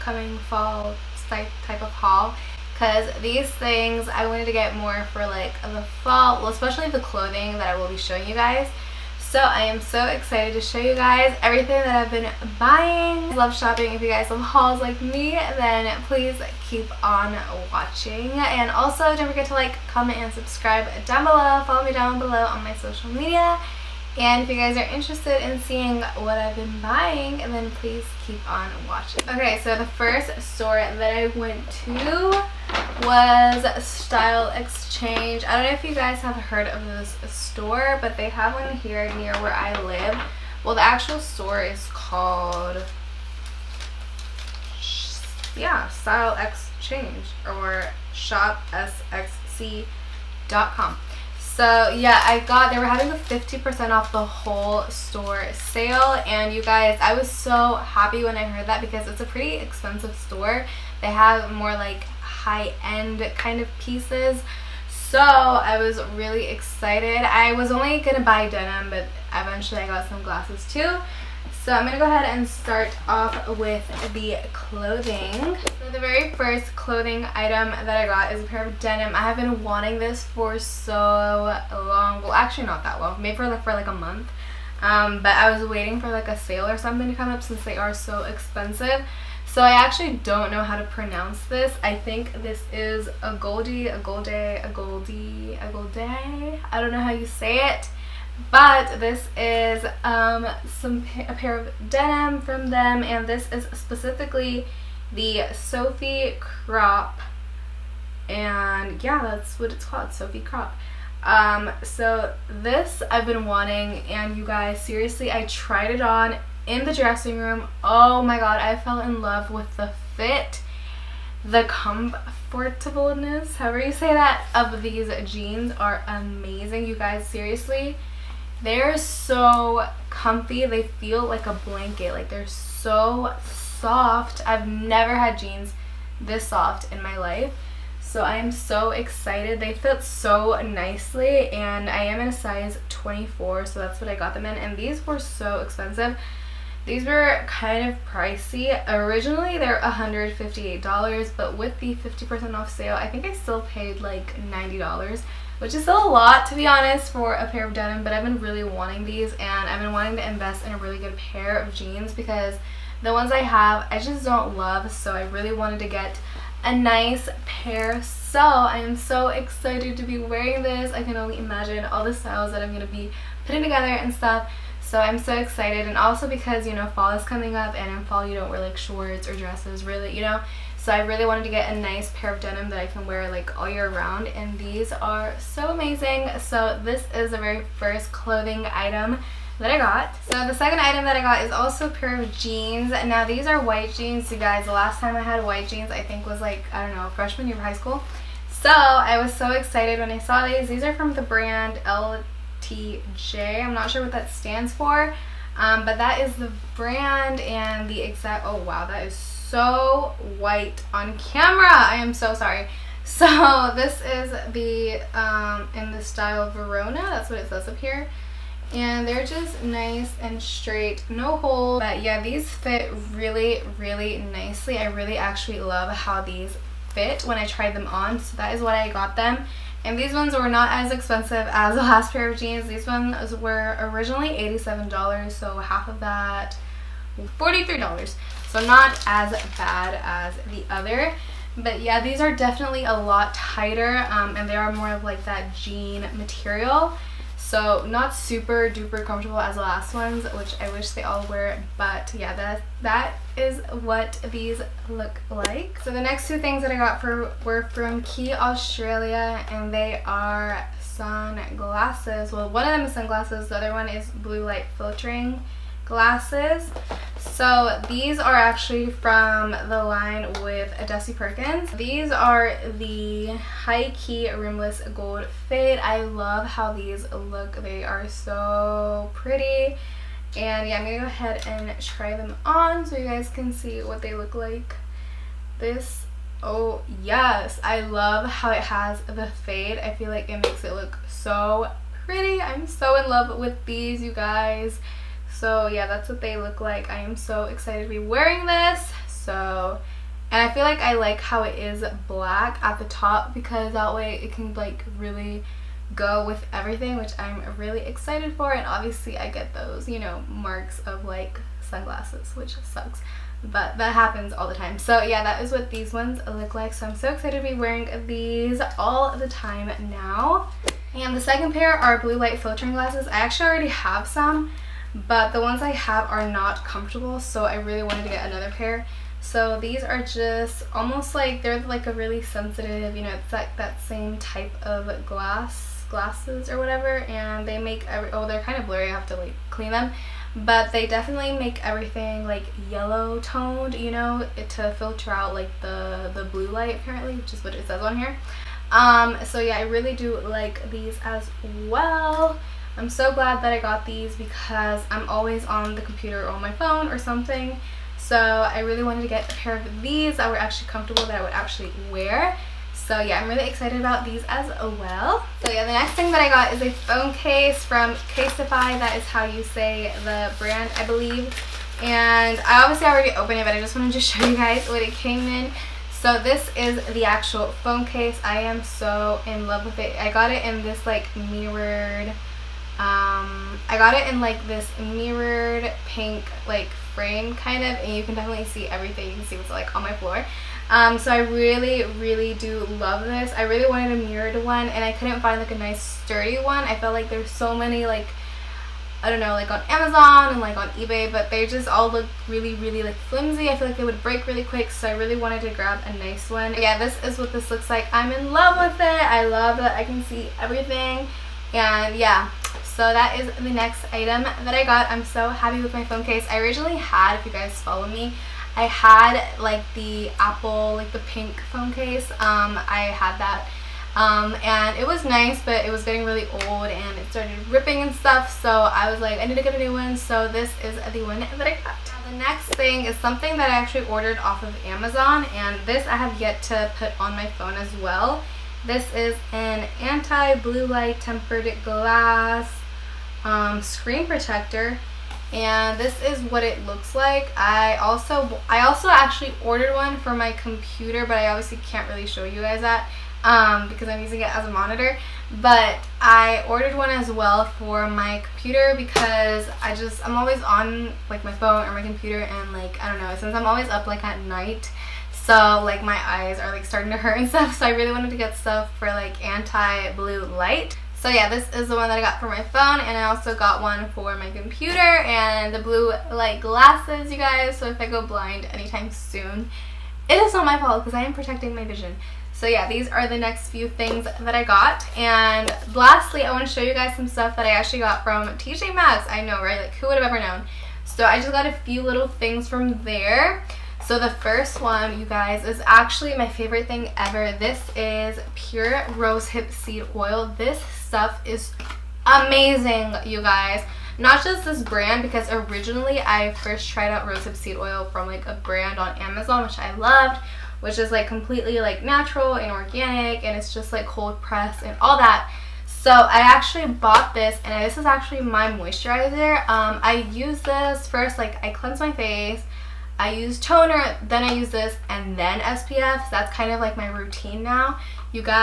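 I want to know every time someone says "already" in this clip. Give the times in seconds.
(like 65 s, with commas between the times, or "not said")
323 s, 372 s.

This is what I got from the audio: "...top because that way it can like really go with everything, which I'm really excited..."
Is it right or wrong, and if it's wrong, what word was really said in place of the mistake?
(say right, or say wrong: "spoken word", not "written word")
right.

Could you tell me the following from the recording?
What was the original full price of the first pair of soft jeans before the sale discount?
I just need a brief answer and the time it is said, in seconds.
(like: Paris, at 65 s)
$158, at 149 s.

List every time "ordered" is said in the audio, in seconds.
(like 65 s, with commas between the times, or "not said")
433 s, 449 s, 456 s.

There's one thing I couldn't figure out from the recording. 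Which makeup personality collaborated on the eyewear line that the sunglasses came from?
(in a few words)
Desi Perkins.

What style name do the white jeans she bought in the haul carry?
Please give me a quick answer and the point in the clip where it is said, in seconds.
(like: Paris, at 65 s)
Verona, at 216 s.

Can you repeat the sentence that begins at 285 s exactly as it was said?
This, oh yes, I love how it has the fade.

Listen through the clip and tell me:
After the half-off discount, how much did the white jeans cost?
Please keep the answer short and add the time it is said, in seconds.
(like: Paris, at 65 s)
$43, at 237 s.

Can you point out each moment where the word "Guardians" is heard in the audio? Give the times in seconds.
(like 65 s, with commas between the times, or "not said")
not said.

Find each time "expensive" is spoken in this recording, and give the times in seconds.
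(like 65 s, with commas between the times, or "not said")
59 s, 88 s, 145 s, 230 s.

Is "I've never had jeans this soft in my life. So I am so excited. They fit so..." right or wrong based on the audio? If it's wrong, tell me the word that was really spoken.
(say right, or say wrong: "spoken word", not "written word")
right.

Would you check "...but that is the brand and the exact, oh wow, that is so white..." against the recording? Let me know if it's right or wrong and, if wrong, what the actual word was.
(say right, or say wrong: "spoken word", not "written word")
right.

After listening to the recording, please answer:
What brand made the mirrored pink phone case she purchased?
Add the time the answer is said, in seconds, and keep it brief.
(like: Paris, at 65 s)
Casetify, at 368 s.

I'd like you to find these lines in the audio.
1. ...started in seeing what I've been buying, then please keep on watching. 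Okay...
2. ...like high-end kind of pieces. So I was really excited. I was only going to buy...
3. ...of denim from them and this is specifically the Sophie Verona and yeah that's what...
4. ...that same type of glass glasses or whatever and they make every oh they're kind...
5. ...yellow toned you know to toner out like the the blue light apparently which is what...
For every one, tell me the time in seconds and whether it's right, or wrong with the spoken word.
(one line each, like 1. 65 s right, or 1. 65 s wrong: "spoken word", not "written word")
1. 24 s wrong: "interested", not "started"
2. 61 s right
3. 101 s wrong: "Crop", not "Verona"
4. 333 s right
5. 342 s wrong: "filter", not "toner".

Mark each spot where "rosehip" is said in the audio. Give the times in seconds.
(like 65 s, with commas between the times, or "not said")
498 s, 507 s.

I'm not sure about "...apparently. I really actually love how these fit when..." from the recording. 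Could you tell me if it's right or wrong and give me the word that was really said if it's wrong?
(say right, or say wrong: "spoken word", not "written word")
wrong: "nicely", not "apparently".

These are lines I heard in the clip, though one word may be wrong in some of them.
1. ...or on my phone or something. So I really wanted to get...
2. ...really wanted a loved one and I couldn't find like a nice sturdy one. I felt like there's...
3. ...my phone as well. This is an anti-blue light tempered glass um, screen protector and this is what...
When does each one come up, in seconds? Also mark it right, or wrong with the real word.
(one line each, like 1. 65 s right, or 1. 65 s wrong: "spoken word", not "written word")
1. 356 s right
2. 393 s wrong: "mirrored", not "loved"
3. 437 s right.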